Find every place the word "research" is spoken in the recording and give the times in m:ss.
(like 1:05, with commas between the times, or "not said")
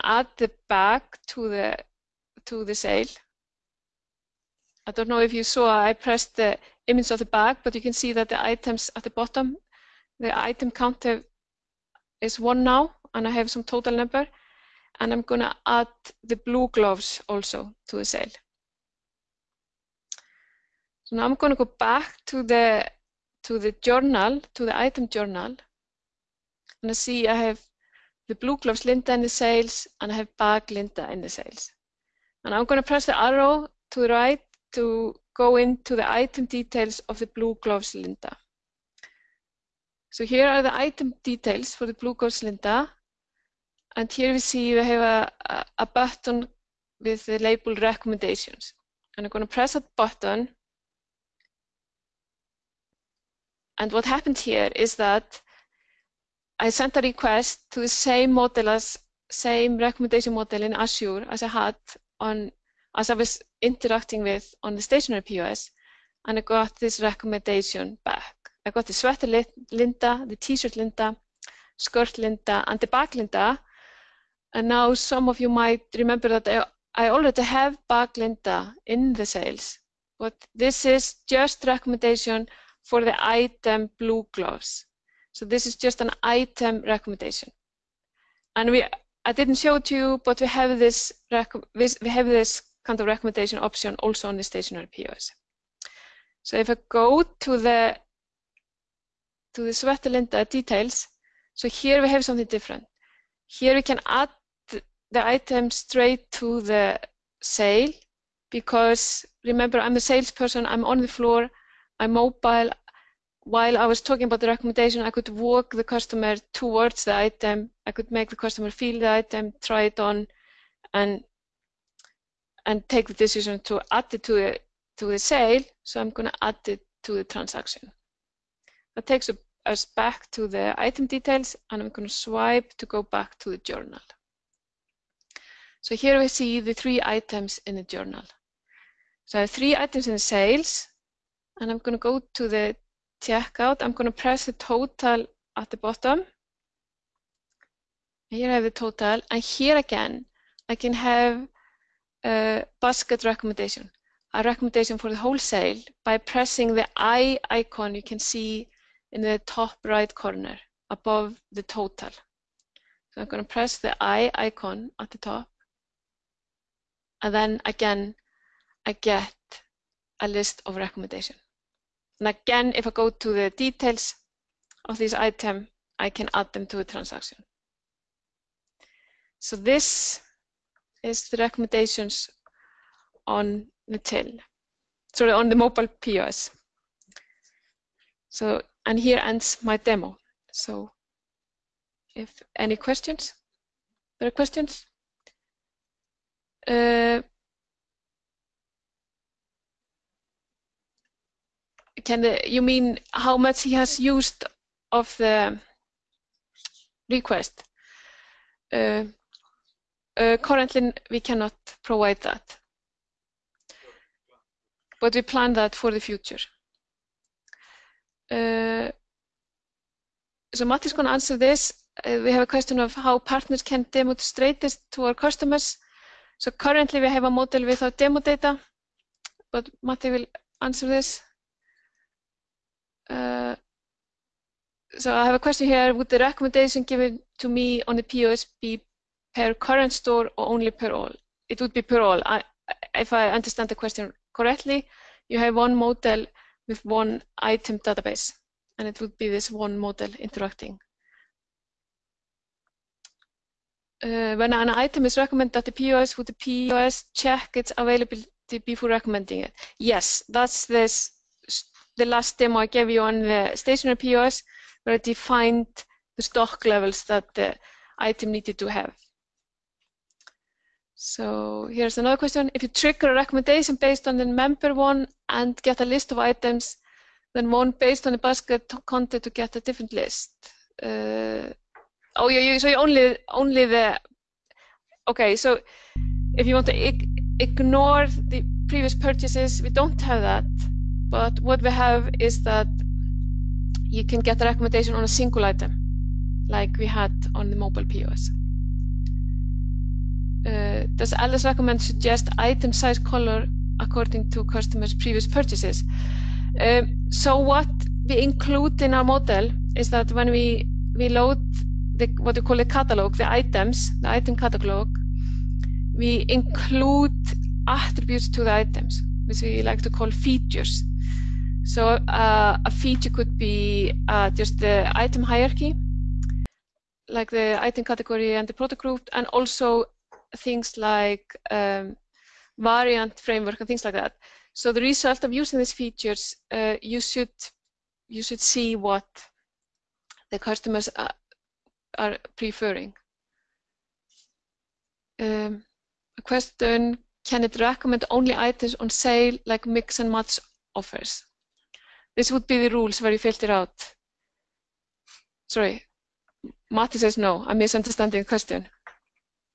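not said.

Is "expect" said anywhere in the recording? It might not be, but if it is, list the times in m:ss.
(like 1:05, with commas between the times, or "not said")
not said.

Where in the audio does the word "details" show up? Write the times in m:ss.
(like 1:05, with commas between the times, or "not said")
0:36, 0:41, 1:40, 2:11, 2:53.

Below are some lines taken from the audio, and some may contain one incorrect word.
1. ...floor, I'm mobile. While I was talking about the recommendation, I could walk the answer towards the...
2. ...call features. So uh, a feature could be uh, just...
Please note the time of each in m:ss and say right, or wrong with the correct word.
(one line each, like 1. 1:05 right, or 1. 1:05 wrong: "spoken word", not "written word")
1. 1:51 wrong: "customer", not "answer"
2. 5:19 right.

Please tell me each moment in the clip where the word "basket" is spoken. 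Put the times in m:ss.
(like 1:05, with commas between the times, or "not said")
2:32, 4:38.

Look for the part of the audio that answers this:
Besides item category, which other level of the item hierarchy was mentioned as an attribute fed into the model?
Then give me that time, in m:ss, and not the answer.
5:28.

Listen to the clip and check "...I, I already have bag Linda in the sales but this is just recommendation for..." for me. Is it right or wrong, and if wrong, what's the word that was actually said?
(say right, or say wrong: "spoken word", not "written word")
right.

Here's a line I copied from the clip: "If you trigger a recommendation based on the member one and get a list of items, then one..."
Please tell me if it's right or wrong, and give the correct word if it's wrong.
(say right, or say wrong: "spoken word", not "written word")
right.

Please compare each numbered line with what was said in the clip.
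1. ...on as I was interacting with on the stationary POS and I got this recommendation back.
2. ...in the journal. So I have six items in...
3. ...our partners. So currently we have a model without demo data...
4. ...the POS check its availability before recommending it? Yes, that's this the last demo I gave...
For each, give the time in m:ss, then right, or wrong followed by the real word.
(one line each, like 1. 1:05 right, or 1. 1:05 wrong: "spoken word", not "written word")
1. 1:02 right
2. 2:17 wrong: "three", not "six"
3. 3:45 wrong: "customers", not "partners"
4. 4:16 right.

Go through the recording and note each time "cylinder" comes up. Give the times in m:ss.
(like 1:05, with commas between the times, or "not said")
0:37, 0:42.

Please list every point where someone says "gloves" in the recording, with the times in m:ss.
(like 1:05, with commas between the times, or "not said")
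0:16, 0:28, 0:37, 0:42, 1:24.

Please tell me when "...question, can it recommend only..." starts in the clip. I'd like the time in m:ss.
5:46.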